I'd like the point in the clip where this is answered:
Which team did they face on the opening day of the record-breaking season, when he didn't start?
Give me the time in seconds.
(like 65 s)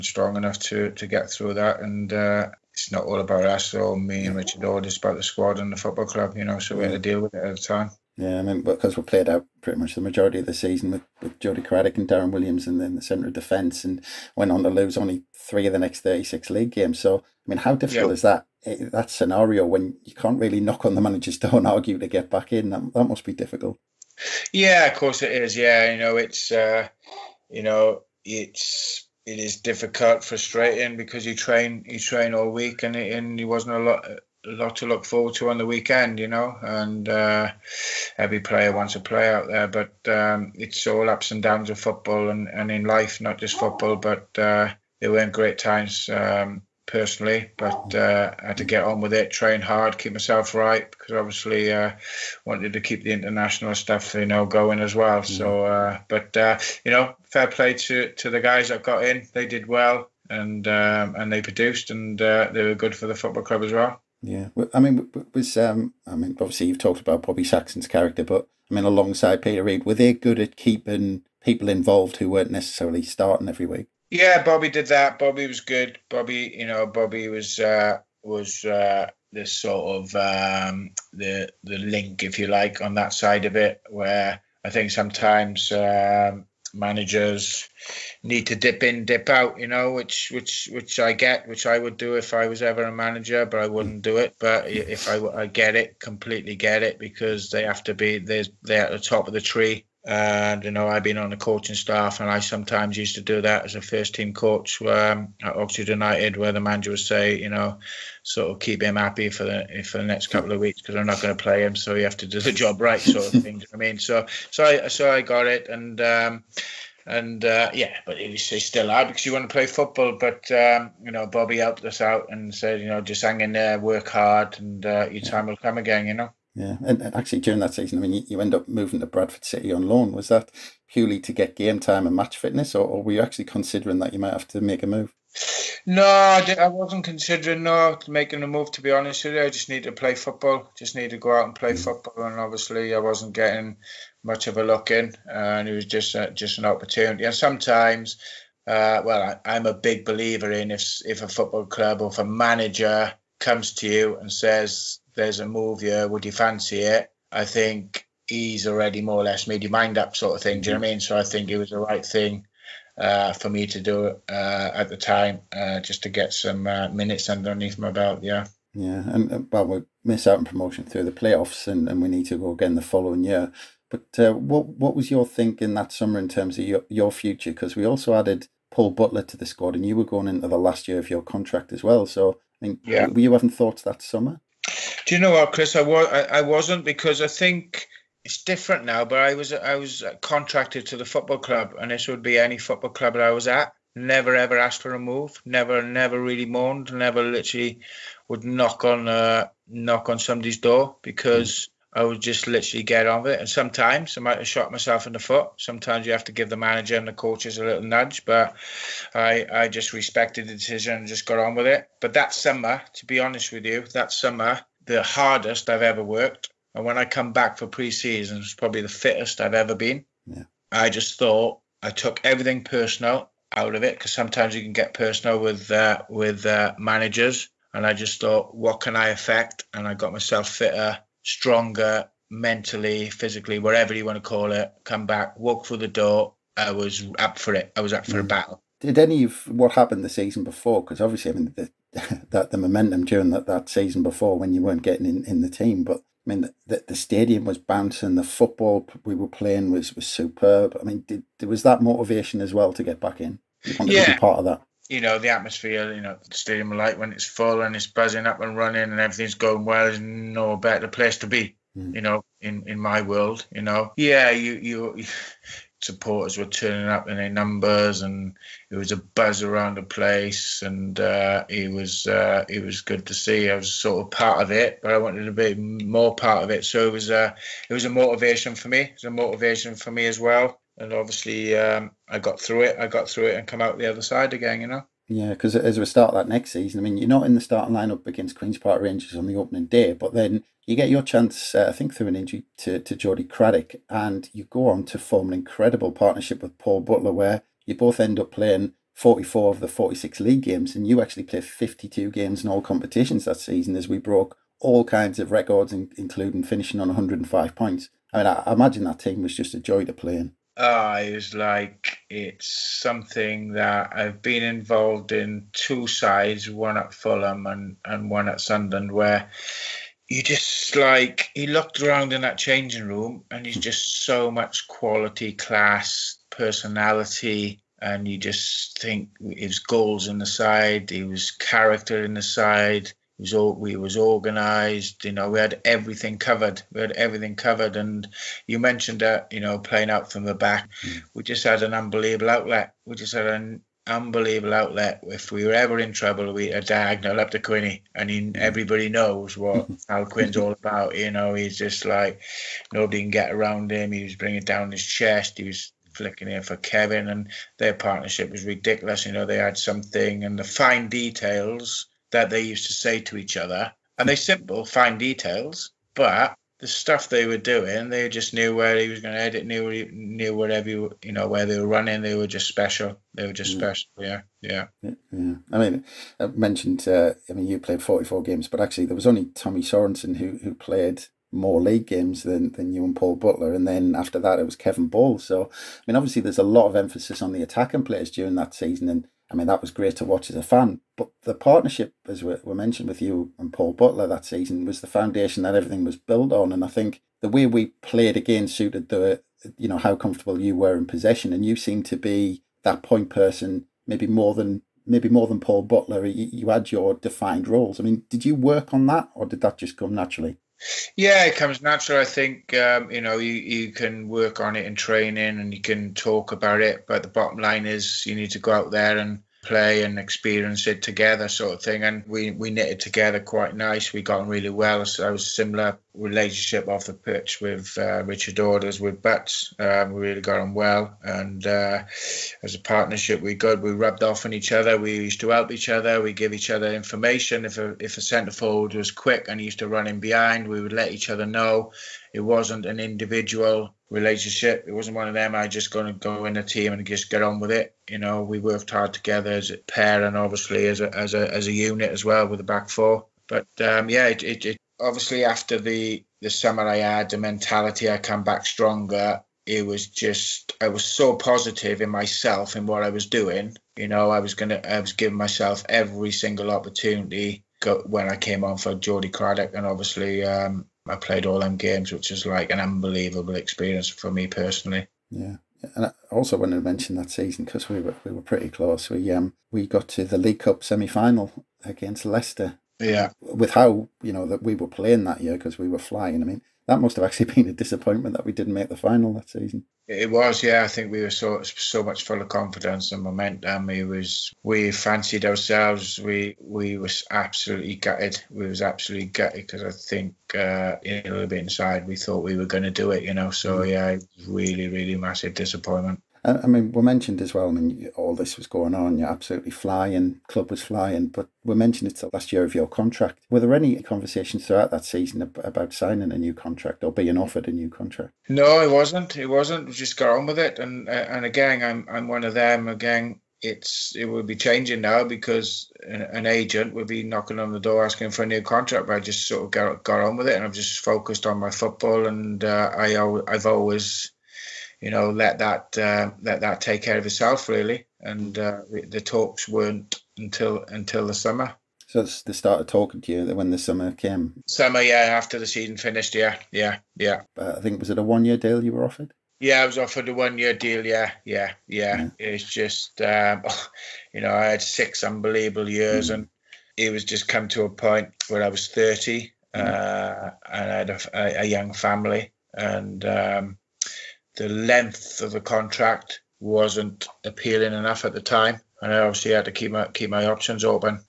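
288 s.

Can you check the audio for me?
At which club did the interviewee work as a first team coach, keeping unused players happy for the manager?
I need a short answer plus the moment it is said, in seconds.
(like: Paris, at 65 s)
Oxford United, at 105 s.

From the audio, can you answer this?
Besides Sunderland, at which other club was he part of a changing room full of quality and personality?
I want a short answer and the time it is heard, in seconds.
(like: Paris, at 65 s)
Fulham, at 316 s.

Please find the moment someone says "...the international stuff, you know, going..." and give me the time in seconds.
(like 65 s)
53 s.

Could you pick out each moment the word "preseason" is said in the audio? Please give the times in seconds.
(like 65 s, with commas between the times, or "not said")
217 s.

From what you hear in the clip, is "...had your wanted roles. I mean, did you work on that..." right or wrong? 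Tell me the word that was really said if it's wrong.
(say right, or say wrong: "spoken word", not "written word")
wrong: "defined", not "wanted".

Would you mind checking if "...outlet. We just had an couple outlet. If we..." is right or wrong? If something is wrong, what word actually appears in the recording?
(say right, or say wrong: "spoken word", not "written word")
wrong: "unbelievable", not "couple".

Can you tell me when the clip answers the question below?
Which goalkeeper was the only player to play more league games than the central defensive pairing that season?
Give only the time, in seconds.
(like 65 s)
379 s.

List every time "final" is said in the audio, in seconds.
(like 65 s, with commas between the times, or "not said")
480 s, 488 s.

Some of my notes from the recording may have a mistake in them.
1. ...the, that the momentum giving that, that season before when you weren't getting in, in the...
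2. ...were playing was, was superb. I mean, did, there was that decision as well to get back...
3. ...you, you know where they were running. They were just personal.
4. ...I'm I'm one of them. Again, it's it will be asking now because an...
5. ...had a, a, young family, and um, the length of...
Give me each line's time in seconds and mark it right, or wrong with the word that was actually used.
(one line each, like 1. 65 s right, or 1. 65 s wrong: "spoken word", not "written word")
1. 241 s wrong: "during", not "giving"
2. 249 s wrong: "motivation", not "decision"
3. 370 s wrong: "special", not "personal"
4. 521 s wrong: "changing", not "asking"
5. 560 s right.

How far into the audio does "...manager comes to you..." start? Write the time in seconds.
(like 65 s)
152 s.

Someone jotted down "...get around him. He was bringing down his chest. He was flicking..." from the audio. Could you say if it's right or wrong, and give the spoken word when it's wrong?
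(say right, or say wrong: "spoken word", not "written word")
right.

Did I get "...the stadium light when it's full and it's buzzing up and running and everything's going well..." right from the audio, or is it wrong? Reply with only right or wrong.
right.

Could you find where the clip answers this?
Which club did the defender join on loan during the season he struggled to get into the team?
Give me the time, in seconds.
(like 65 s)
129 s.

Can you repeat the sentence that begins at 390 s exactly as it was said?
But the partnership, as we mentioned with you and Paul Butler that season, was the foundation that everything was built on.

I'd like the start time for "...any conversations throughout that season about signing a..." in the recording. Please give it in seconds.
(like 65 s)
513 s.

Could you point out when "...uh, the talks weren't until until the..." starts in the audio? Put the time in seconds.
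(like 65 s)
538 s.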